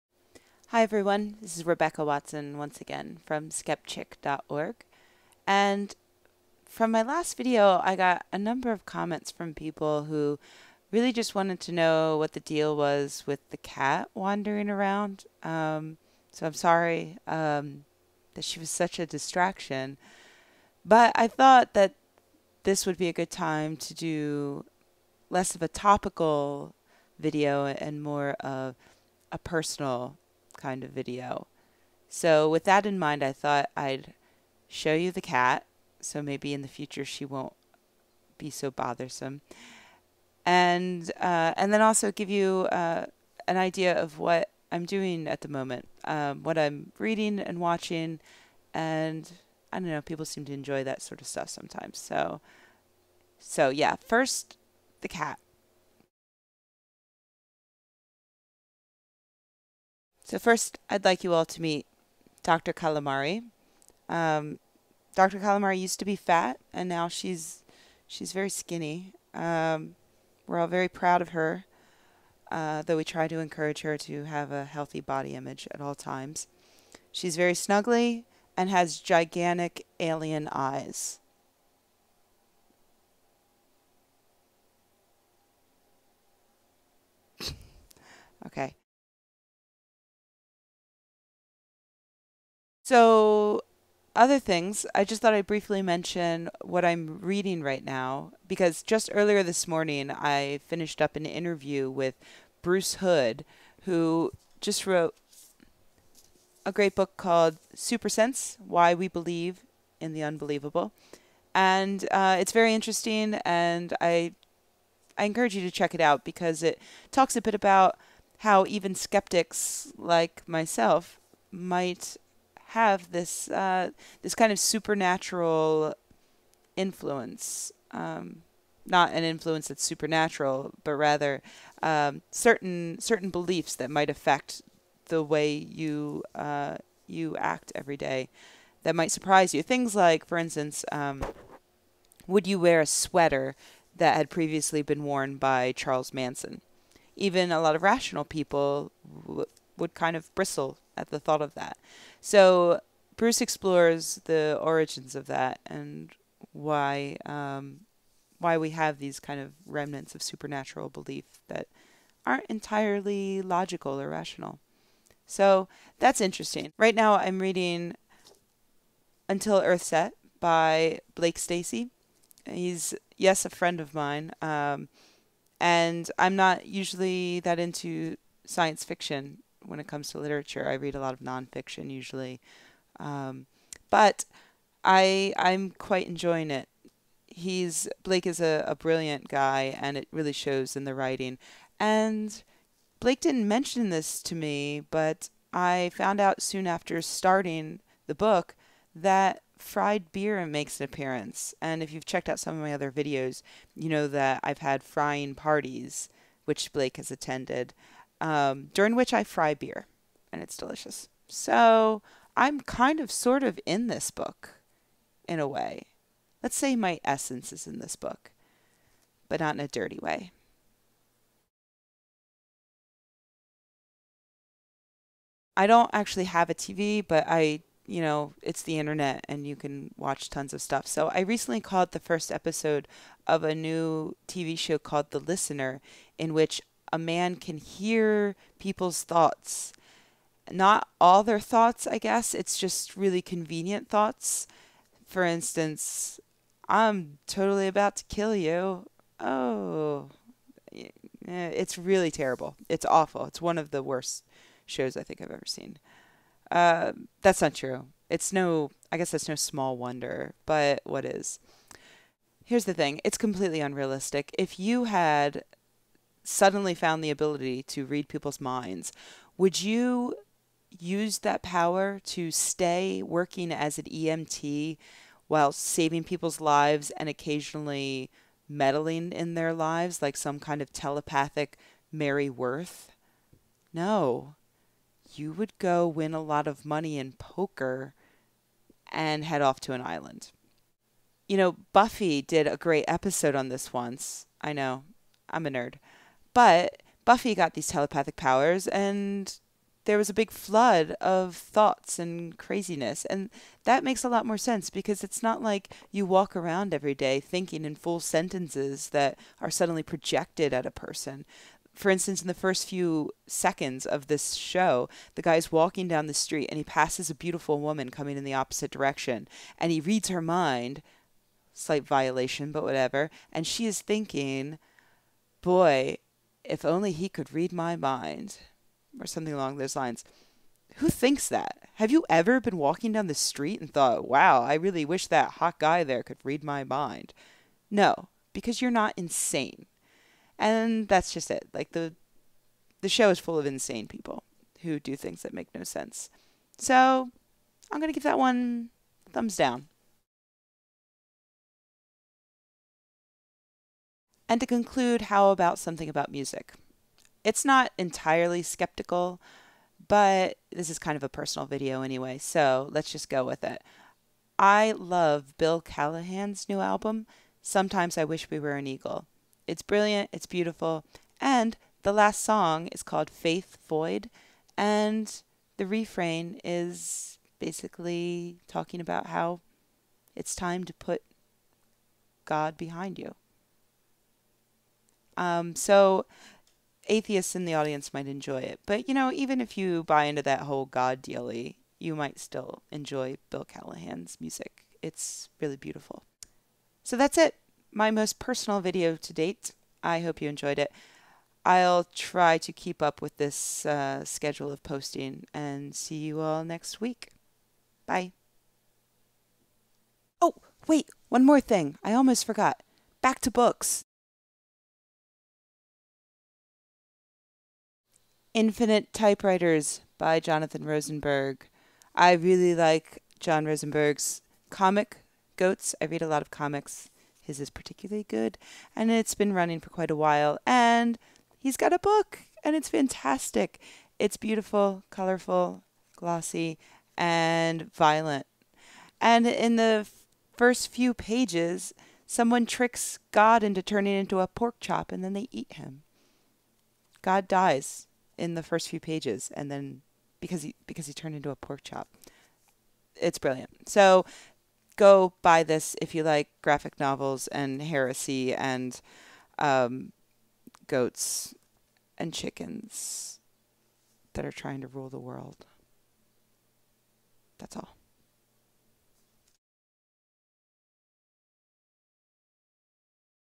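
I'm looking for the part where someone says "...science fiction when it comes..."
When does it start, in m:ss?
2:58.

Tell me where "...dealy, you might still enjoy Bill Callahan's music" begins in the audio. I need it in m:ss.
6:31.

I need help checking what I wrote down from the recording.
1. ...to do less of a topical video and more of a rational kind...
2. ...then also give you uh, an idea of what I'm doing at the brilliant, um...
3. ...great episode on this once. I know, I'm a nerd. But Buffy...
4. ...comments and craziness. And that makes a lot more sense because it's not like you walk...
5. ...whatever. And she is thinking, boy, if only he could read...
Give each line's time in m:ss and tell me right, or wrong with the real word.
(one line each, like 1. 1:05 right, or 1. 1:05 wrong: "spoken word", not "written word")
1. 0:23 wrong: "personal", not "rational"
2. 0:41 wrong: "moment", not "brilliant"
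3. 4:52 right
4. 5:01 wrong: "thoughts", not "comments"
5. 5:22 right.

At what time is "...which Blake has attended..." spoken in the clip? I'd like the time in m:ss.
3:26.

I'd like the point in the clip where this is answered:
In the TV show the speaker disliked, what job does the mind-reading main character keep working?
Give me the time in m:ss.
4:33.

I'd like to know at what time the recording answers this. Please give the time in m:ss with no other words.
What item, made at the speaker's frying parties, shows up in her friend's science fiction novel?
3:19.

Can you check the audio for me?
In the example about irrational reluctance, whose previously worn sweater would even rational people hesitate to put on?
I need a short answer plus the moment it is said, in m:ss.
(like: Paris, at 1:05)
Charles Manson, at 2:25.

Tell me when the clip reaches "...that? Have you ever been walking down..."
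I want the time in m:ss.
5:31.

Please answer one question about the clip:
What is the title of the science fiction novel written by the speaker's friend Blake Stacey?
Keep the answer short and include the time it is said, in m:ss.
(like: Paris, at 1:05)
Until Earth Set, at 2:49.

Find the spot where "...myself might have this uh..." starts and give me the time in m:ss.
2:00.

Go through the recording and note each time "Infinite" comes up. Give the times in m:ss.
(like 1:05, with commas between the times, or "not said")
6:58.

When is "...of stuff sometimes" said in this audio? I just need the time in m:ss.
0:51.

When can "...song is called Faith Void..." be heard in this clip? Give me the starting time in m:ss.
6:12.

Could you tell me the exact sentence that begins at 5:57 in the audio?
It's not entirely skeptical, but this is kind of a personal video anyway, so let's just go with it.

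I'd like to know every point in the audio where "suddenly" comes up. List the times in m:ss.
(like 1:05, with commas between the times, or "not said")
4:26, 5:09.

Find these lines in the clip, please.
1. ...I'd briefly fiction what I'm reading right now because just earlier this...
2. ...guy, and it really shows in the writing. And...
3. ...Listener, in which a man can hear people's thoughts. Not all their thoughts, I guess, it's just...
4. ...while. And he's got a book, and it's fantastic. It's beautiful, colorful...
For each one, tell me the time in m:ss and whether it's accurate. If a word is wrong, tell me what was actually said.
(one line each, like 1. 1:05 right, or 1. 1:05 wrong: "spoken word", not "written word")
1. 1:35 wrong: "mention", not "fiction"
2. 3:09 right
3. 3:55 right
4. 7:09 right.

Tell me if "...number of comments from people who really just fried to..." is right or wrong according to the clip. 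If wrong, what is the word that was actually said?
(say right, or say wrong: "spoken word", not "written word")
wrong: "wanted", not "fried".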